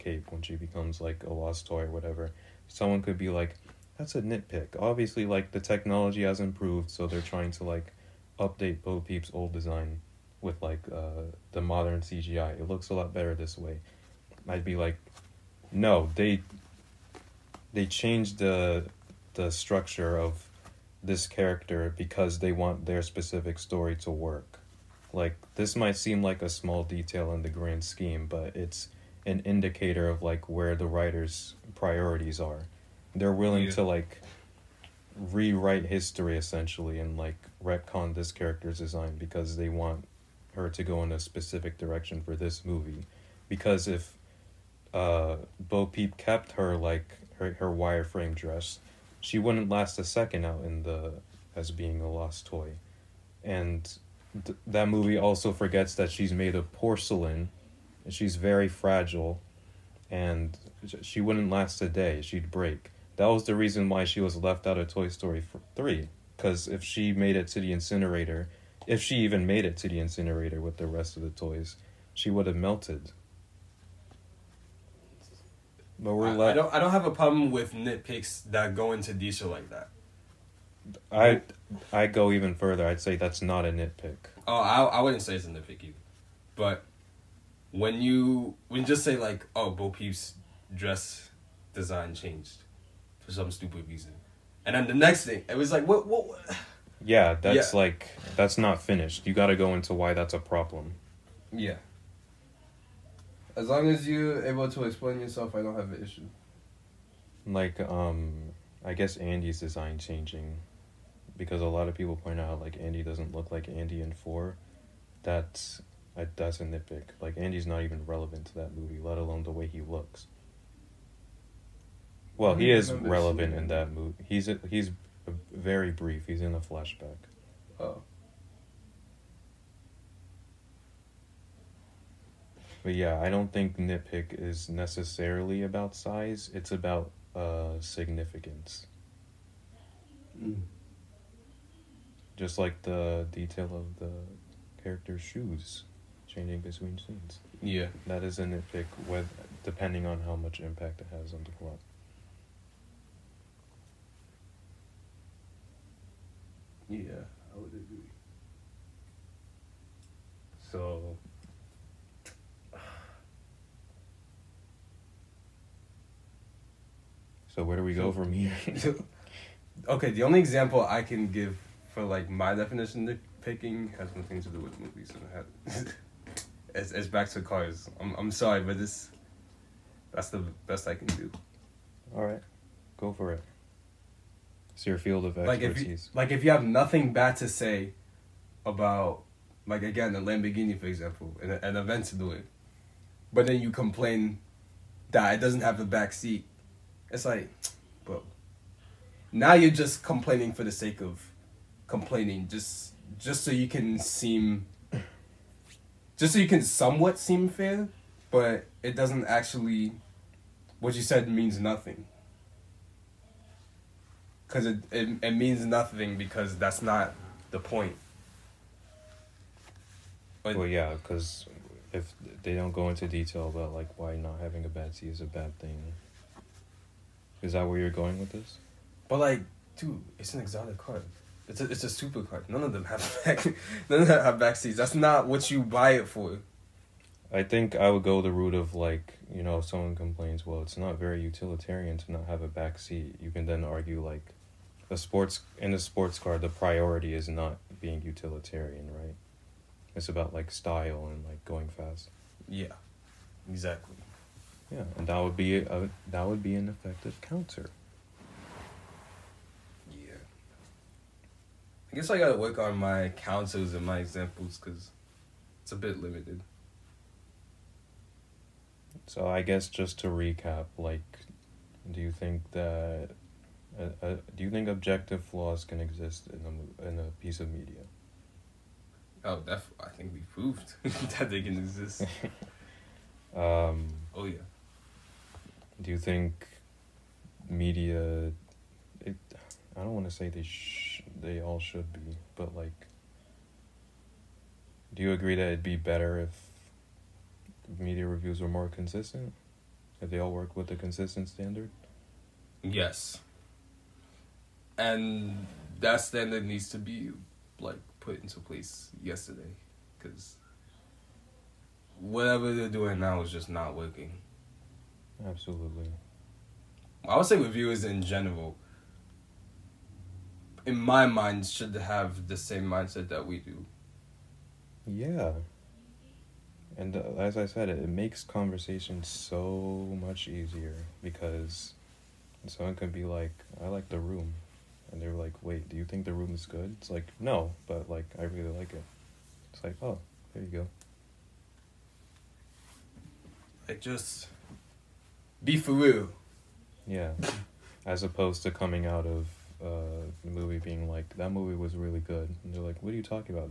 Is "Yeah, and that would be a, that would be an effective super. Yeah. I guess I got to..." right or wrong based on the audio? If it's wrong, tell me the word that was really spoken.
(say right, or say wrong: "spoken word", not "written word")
wrong: "counter", not "super".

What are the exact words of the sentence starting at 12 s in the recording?
It looks a lot better this way.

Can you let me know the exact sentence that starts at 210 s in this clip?
What you said means nothing because it, it, it means nothing because that's not the point.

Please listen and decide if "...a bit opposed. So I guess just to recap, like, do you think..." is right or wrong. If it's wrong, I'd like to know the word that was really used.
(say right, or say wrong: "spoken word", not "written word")
wrong: "limited", not "opposed".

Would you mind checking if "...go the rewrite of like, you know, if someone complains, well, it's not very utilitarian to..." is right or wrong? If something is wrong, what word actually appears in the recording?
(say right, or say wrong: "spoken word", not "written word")
wrong: "route", not "rewrite".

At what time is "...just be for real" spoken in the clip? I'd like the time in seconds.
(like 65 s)
343 s.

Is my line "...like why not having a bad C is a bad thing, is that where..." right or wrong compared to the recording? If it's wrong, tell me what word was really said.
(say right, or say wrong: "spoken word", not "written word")
right.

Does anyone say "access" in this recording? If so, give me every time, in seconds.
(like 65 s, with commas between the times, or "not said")
not said.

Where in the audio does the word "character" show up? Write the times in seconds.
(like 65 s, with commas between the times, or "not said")
21 s, 38 s, 144 s.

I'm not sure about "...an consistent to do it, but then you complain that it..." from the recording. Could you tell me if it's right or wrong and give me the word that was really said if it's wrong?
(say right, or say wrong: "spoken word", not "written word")
wrong: "event", not "consistent".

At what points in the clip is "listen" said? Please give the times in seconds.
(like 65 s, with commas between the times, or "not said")
not said.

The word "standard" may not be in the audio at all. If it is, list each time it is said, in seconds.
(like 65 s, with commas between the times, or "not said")
301 s, 306 s.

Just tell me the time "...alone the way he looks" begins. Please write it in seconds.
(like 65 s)
119 s.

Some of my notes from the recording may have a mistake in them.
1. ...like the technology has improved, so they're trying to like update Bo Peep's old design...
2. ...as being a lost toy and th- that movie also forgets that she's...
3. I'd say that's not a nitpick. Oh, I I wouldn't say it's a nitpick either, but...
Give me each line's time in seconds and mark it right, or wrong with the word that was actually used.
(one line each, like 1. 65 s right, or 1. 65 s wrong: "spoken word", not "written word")
1. 5 s right
2. 51 s right
3. 82 s right.